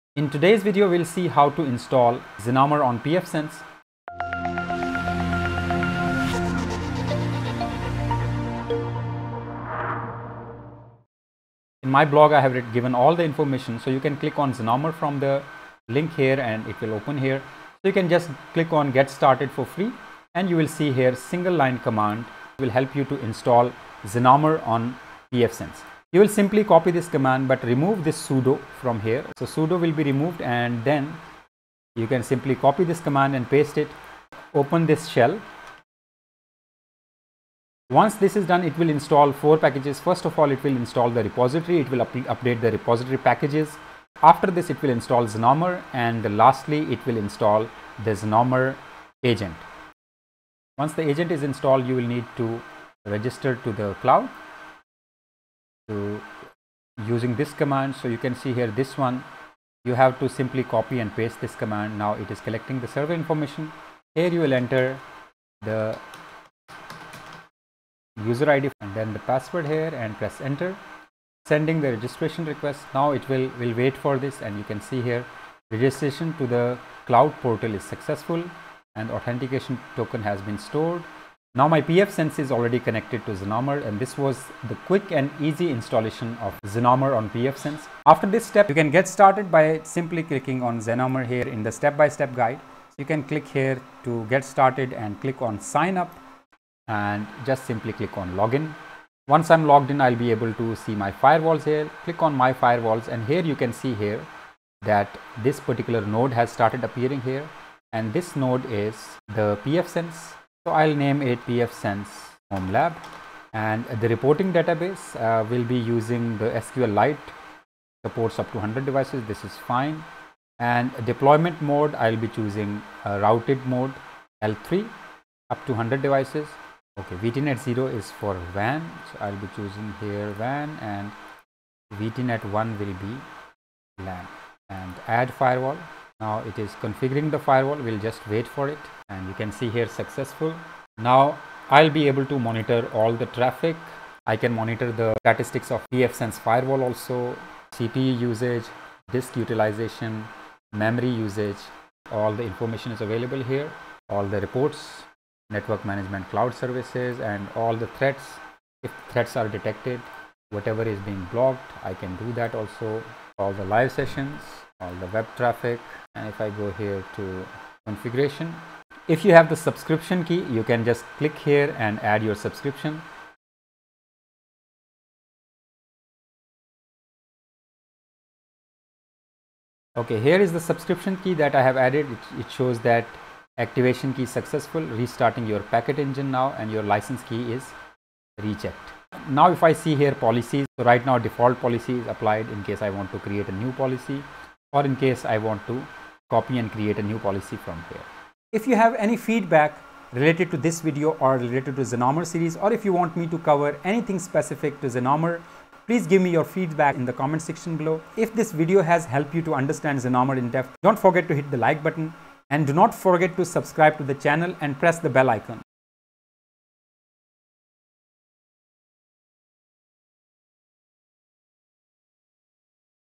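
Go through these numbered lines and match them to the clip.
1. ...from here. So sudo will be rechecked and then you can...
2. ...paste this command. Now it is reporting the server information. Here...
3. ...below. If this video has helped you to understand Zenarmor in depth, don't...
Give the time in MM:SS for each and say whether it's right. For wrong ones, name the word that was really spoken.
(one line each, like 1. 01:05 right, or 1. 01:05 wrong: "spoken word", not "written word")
1. 00:28 wrong: "removed", not "rechecked"
2. 01:01 wrong: "collecting", not "reporting"
3. 03:27 right.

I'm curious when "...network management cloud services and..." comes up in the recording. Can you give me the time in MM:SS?
02:35.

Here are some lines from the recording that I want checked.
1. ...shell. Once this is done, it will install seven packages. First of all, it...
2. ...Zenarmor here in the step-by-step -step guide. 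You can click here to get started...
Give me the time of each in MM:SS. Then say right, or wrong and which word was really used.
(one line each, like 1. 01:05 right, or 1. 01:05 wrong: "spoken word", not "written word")
1. 00:35 wrong: "four", not "seven"
2. 01:30 right.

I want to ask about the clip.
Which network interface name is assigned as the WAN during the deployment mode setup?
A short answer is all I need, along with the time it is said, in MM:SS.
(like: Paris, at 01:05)
VTNet 0, at 02:07.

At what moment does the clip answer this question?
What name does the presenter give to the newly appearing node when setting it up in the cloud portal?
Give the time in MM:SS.
01:51.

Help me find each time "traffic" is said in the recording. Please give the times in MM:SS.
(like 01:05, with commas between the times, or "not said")
02:23, 02:45.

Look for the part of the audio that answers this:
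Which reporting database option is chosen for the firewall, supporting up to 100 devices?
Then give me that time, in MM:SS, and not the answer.
01:56.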